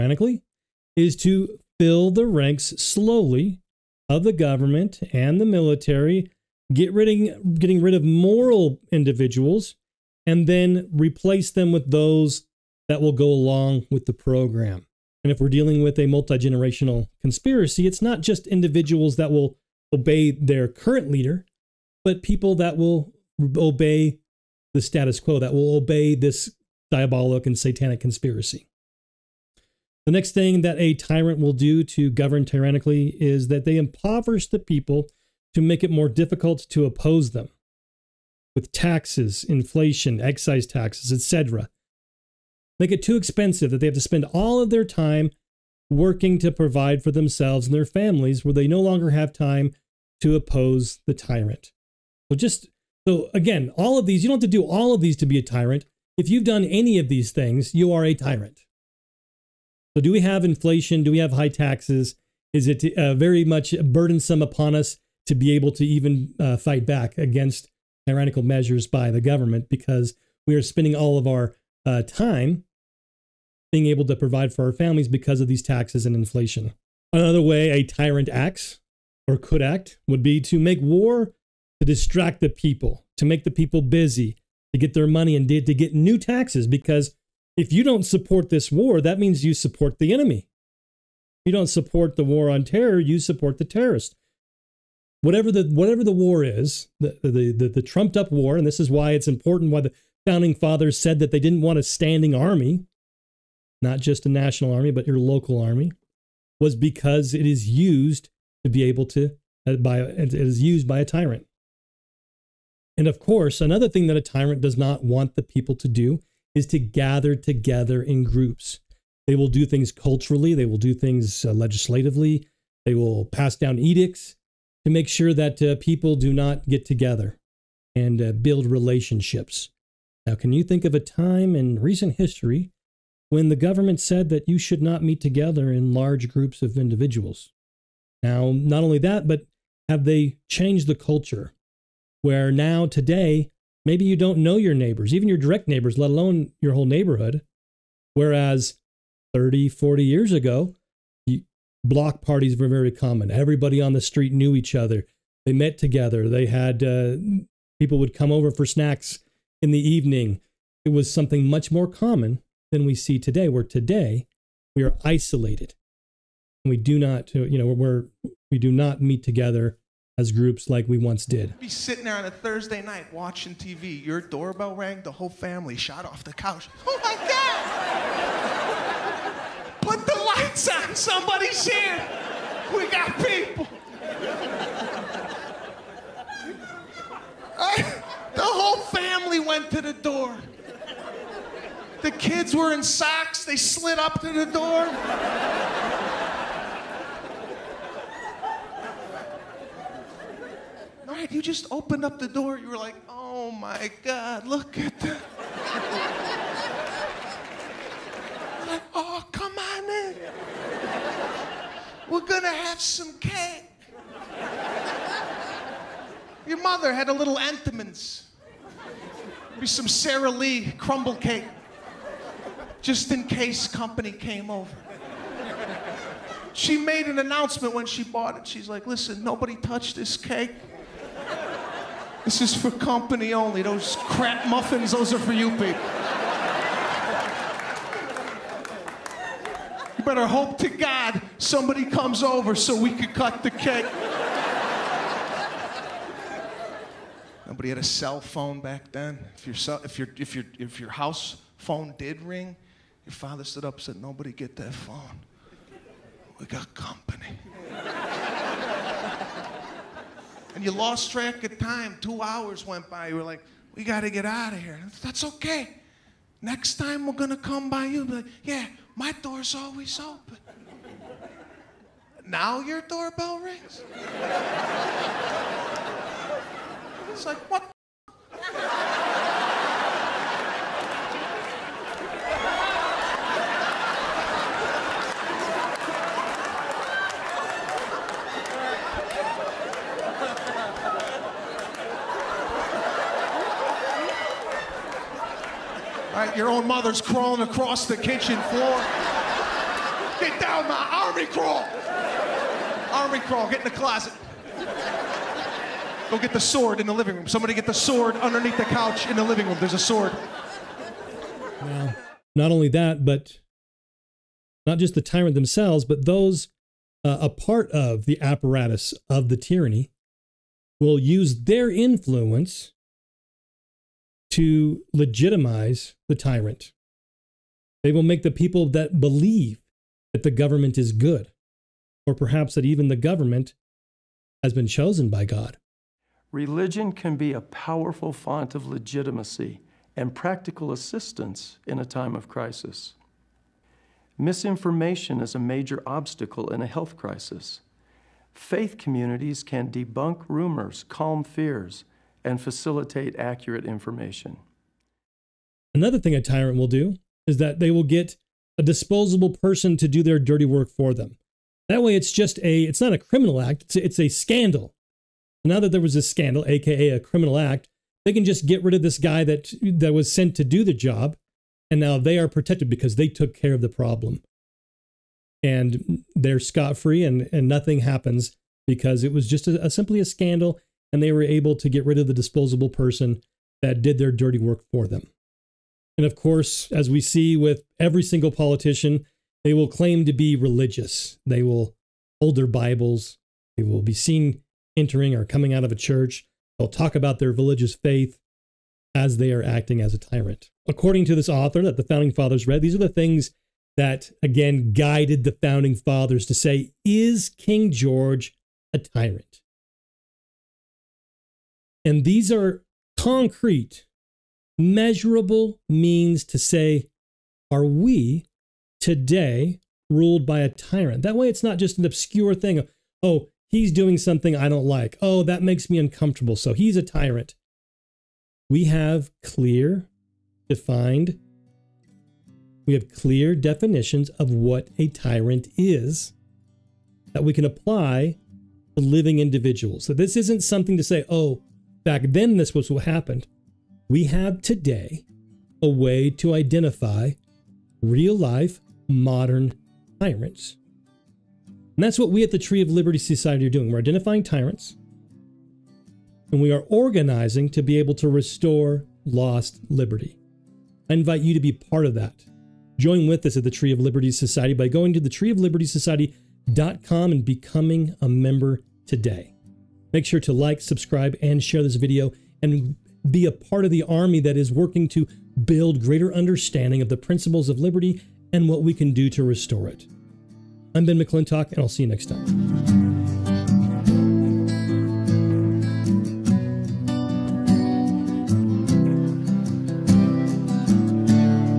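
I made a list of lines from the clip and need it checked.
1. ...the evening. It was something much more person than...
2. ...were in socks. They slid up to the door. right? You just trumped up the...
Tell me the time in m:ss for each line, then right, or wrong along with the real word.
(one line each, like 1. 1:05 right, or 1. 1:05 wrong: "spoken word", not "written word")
1. 2:39 wrong: "common", not "person"
2. 3:12 wrong: "opened", not "trumped".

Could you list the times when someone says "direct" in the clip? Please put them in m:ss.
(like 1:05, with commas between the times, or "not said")
2:25.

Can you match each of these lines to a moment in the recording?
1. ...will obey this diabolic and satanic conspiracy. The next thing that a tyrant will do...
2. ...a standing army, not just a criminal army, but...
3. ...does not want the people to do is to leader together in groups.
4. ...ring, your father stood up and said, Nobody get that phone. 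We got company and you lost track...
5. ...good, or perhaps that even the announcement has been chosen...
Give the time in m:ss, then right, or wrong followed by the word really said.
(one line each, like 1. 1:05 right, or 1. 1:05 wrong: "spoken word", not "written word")
1. 0:25 right
2. 1:41 wrong: "national", not "criminal"
3. 1:54 wrong: "gather", not "leader"
4. 4:12 right
5. 5:30 wrong: "government", not "announcement".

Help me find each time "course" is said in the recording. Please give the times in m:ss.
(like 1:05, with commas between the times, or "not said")
1:53, 6:26.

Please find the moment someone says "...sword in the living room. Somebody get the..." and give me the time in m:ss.
5:06.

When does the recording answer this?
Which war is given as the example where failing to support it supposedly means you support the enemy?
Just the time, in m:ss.
1:32.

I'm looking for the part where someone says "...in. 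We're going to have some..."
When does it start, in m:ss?
3:29.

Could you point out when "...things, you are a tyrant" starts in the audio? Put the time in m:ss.
0:57.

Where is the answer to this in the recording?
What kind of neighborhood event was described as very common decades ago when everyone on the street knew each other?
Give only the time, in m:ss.
2:31.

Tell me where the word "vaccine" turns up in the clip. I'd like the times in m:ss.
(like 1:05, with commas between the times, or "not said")
not said.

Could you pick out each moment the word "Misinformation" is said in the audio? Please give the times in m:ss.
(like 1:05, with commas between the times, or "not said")
5:44.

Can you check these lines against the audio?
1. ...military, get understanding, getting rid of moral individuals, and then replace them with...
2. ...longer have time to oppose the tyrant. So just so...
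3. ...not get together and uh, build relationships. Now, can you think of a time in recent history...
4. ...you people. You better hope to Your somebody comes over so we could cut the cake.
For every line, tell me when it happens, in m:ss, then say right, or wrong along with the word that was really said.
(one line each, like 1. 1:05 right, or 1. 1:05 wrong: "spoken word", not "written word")
1. 0:05 wrong: "ridding", not "understanding"
2. 0:48 right
3. 2:06 right
4. 3:55 wrong: "God", not "Your".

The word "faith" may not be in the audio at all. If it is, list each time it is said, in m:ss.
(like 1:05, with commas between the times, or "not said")
5:48, 6:37.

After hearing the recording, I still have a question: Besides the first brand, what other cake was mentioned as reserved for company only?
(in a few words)
Sara Lee crumble cake.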